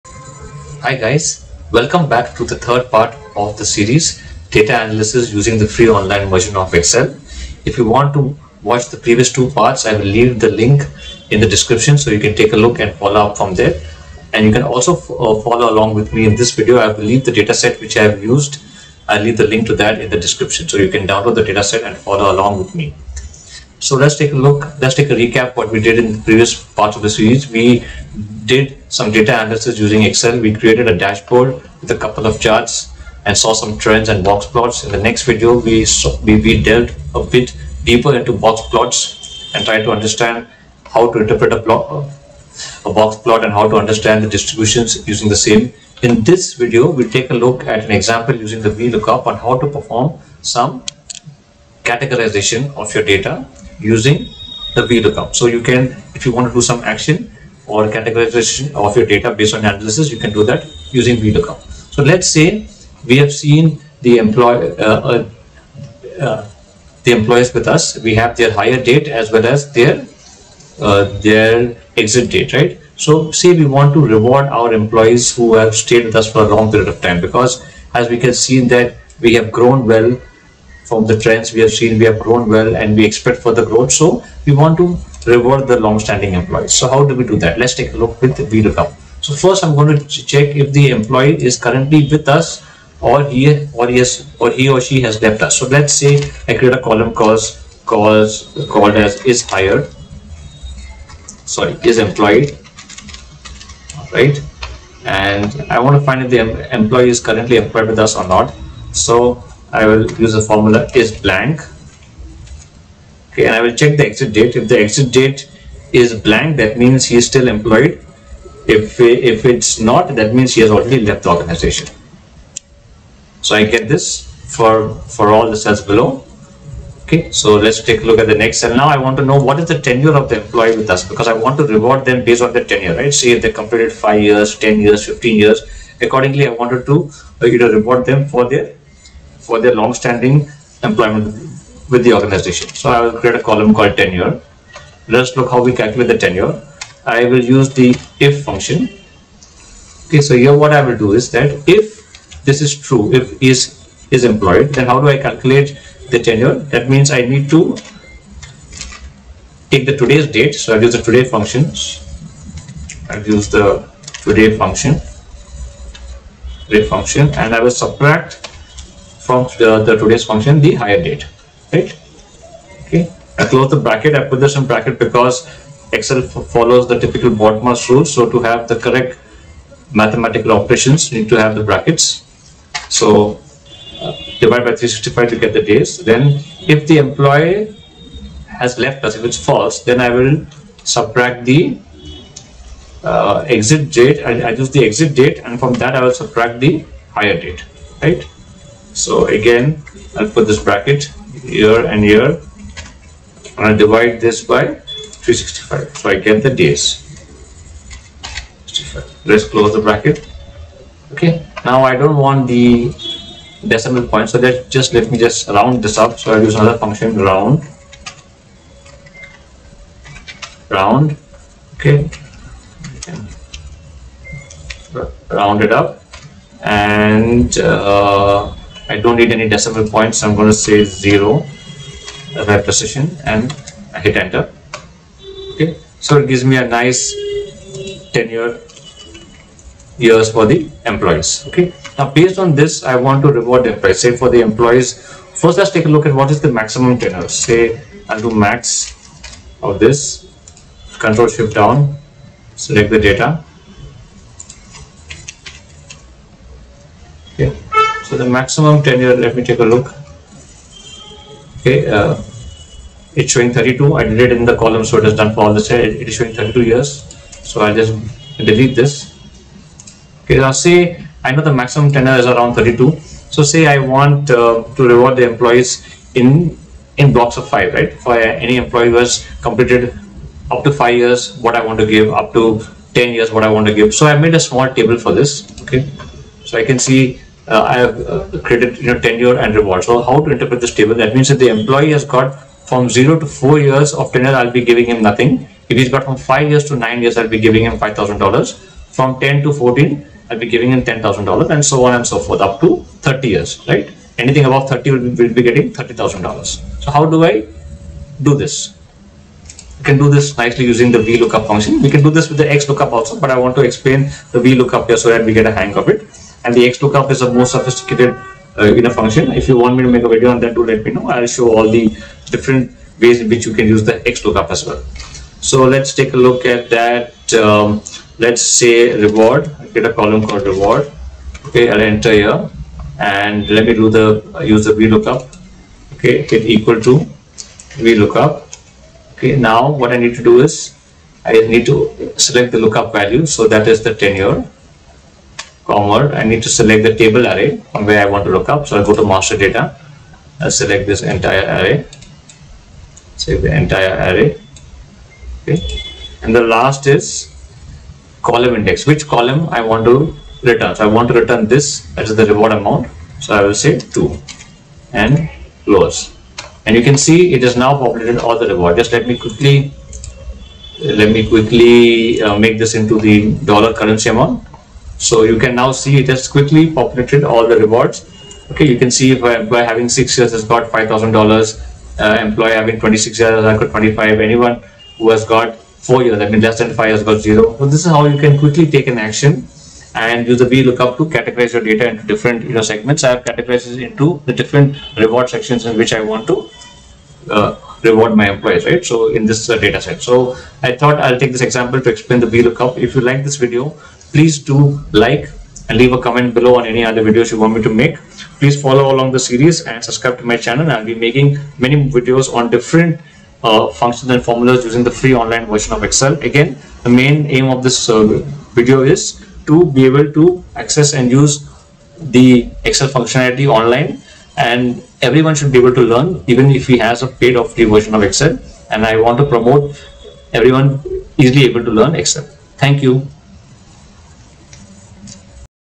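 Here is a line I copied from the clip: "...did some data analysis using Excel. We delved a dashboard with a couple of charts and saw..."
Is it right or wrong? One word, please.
wrong.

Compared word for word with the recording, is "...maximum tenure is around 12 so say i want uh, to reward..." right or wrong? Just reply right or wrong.
wrong.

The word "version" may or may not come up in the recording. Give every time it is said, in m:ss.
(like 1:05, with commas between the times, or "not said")
0:06, 6:55, 7:07.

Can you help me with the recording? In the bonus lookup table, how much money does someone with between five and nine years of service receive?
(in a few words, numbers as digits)
$5,000.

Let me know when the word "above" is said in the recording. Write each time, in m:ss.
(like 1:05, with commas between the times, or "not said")
5:04.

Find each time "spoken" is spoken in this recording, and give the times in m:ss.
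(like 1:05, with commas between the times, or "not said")
not said.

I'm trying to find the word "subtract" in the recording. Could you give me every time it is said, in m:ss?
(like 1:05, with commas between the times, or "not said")
2:47, 3:10, 3:16.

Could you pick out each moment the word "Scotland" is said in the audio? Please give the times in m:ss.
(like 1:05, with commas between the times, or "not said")
not said.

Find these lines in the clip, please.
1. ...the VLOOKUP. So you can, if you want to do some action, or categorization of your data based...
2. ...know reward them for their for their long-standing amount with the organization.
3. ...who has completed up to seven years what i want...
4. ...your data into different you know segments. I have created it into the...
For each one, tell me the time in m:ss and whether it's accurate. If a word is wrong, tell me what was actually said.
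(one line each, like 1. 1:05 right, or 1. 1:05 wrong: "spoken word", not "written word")
1. 0:54 right
2. 2:17 wrong: "employment", not "amount"
3. 4:38 wrong: "five", not "seven"
4. 6:31 wrong: "categorized", not "created".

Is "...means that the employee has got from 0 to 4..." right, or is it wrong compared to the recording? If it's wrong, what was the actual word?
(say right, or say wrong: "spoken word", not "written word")
right.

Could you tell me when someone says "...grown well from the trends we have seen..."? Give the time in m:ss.
1:19.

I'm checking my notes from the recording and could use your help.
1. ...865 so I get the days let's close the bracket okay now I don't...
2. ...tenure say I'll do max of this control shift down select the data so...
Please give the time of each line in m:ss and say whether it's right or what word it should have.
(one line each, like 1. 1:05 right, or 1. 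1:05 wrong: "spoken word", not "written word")
1. 3:25 wrong: "365", not "865"
2. 4:07 right.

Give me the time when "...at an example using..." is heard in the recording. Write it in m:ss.
0:47.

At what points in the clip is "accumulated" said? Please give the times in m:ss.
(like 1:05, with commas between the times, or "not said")
not said.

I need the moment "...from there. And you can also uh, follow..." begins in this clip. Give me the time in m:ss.
0:13.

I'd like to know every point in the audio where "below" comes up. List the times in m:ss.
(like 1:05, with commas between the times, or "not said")
2:05, 6:46.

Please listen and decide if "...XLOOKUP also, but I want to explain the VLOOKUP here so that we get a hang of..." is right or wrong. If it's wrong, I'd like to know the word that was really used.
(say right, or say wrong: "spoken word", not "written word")
right.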